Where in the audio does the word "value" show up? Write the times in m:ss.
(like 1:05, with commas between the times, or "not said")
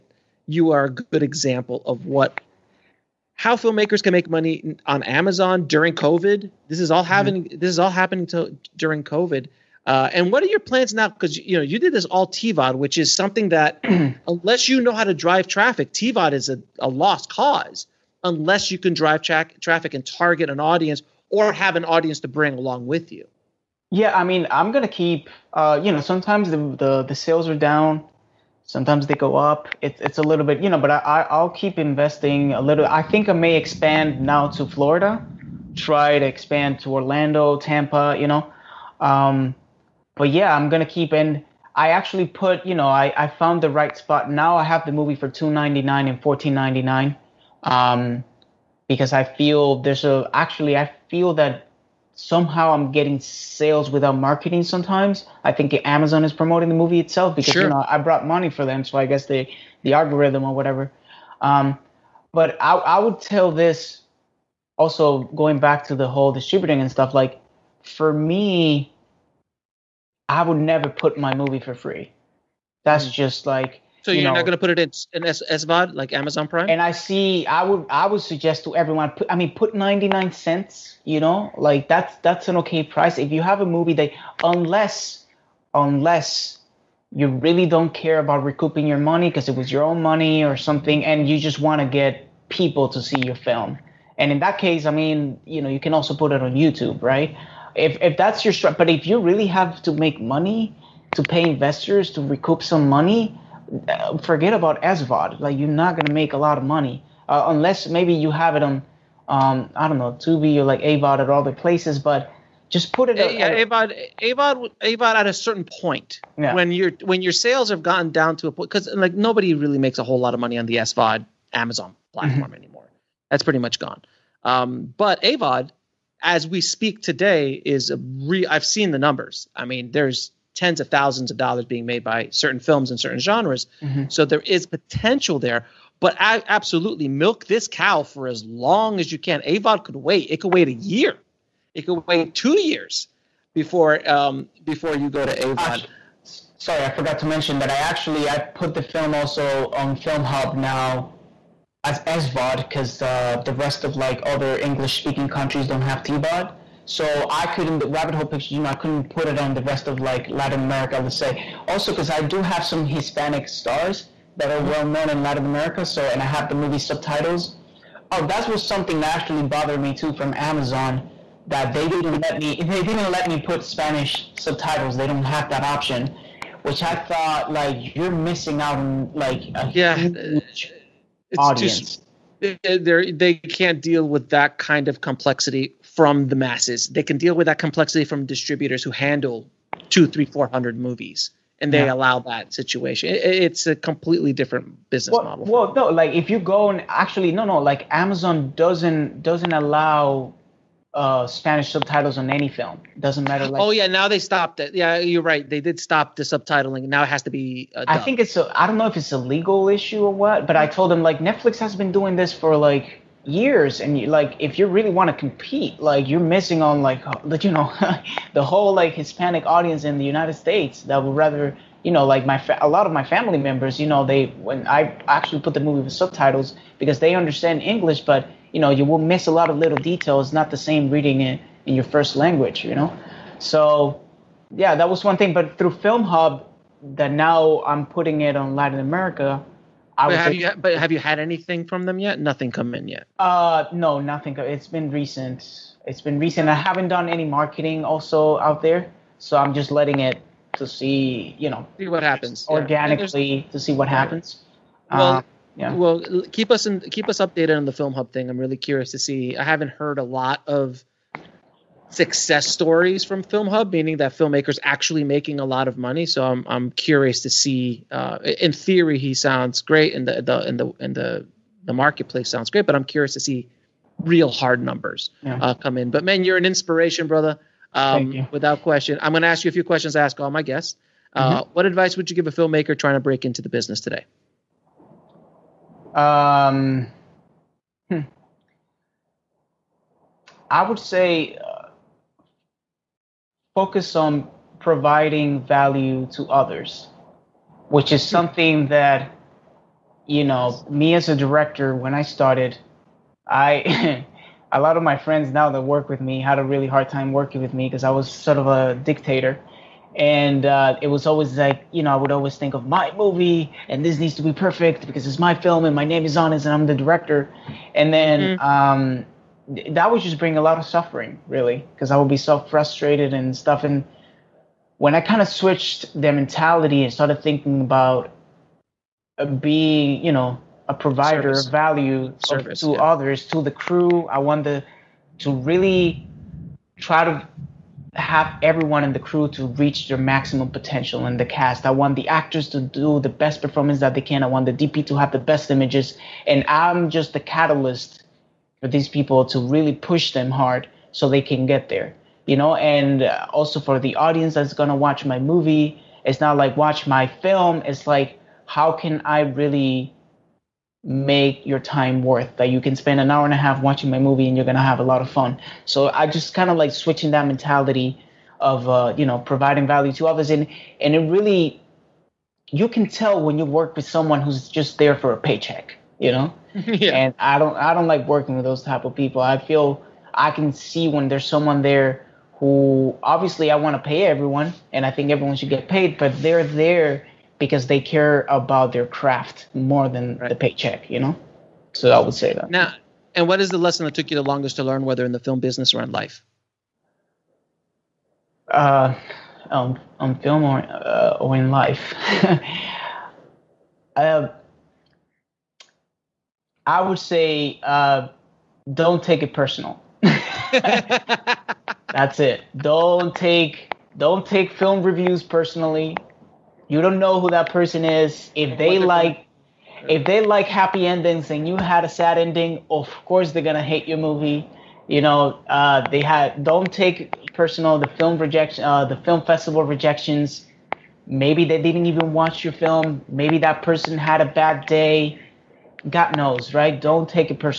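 4:55, 5:31, 6:09.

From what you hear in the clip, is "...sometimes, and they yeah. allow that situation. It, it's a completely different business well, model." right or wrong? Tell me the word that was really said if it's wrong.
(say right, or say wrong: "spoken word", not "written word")
wrong: "movies", not "sometimes".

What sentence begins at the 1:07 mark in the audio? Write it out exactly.
Like for me, I would never put my movie for free.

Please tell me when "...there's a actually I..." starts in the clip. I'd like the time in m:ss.
0:49.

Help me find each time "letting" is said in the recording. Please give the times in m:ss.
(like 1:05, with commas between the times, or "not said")
4:09.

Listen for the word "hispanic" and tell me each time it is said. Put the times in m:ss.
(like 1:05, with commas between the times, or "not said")
2:42, 3:38.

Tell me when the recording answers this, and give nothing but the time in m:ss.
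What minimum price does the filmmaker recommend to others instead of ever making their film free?
1:19.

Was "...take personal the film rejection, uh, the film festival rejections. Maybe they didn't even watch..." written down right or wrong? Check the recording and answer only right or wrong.
right.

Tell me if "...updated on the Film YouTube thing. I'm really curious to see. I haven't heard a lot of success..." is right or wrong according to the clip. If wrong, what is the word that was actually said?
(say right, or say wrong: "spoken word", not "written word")
wrong: "Hub", not "YouTube".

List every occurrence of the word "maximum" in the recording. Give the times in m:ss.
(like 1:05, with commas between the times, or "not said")
5:39.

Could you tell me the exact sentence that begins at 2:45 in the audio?
So and I have the movie subtitles.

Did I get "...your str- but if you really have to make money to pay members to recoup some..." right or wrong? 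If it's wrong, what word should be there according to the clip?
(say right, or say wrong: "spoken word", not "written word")
wrong: "investors", not "members".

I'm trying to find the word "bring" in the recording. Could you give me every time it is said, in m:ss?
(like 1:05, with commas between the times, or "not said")
0:22, 5:20.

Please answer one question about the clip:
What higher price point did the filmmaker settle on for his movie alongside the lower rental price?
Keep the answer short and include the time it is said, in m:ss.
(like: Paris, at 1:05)
$14.99, at 0:46.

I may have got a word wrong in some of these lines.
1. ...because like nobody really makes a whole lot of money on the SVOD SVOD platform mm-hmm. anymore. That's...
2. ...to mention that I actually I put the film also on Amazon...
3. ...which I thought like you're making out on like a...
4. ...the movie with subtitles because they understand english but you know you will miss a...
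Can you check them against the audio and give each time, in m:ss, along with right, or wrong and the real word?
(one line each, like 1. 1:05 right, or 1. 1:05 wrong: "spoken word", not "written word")
1. 1:58 wrong: "Amazon", not "SVOD"
2. 2:27 wrong: "Film", not "Amazon"
3. 2:56 wrong: "missing", not "making"
4. 3:45 right.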